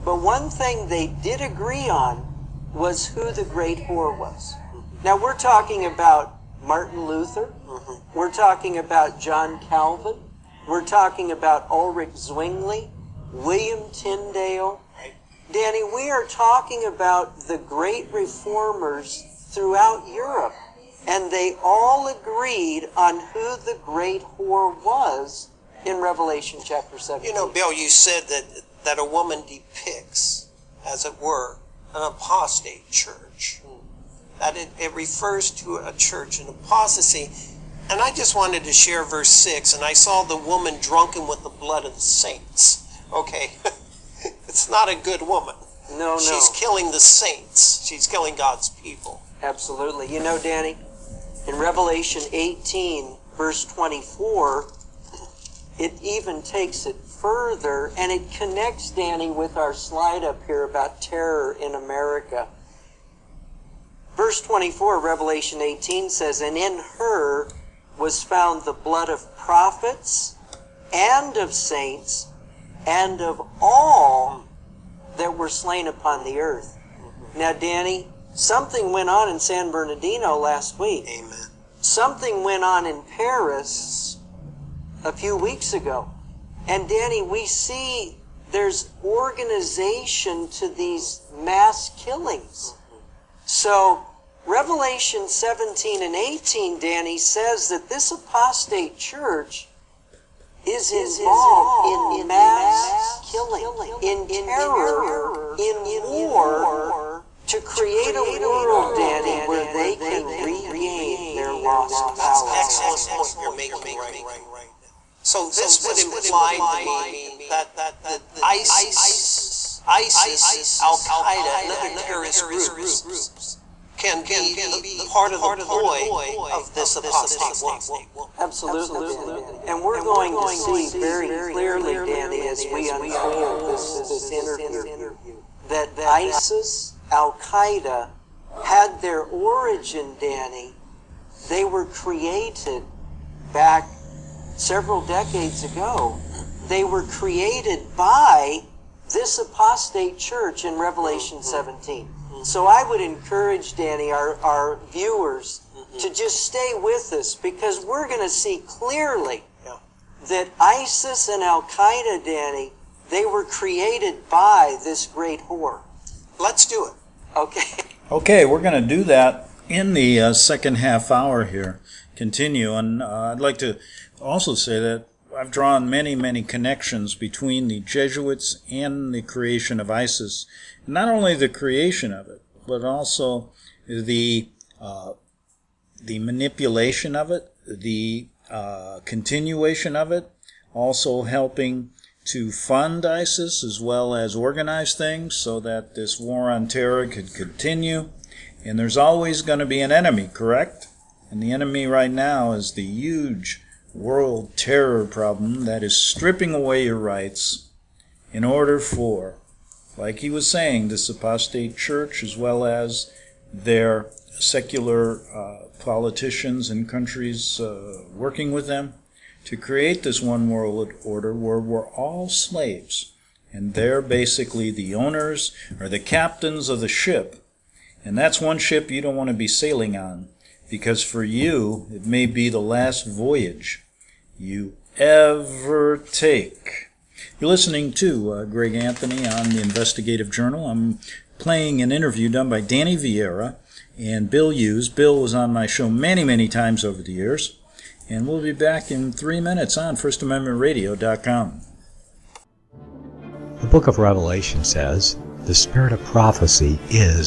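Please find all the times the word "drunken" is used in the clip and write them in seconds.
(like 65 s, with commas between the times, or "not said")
40 s.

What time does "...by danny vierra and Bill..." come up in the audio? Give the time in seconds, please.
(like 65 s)
242 s.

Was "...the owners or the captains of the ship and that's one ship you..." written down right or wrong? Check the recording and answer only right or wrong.
right.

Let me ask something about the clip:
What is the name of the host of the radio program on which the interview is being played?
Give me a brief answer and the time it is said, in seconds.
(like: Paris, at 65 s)
Greg Anthony, at 238 s.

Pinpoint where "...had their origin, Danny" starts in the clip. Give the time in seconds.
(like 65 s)
138 s.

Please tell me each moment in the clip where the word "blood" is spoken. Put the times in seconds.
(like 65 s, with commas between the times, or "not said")
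41 s, 68 s.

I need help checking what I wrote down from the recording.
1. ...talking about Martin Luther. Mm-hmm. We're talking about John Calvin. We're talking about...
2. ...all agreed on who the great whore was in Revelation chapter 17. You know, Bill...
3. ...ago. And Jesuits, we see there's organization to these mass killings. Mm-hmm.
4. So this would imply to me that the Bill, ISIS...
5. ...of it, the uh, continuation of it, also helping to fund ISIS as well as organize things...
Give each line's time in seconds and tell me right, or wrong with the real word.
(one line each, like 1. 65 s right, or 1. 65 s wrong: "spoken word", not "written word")
1. 5 s right
2. 21 s right
3. 85 s wrong: "Danny", not "Jesuits"
4. 115 s wrong: "ISIS", not "Bill"
5. 187 s right.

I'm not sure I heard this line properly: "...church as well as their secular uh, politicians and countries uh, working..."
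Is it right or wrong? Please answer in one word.
right.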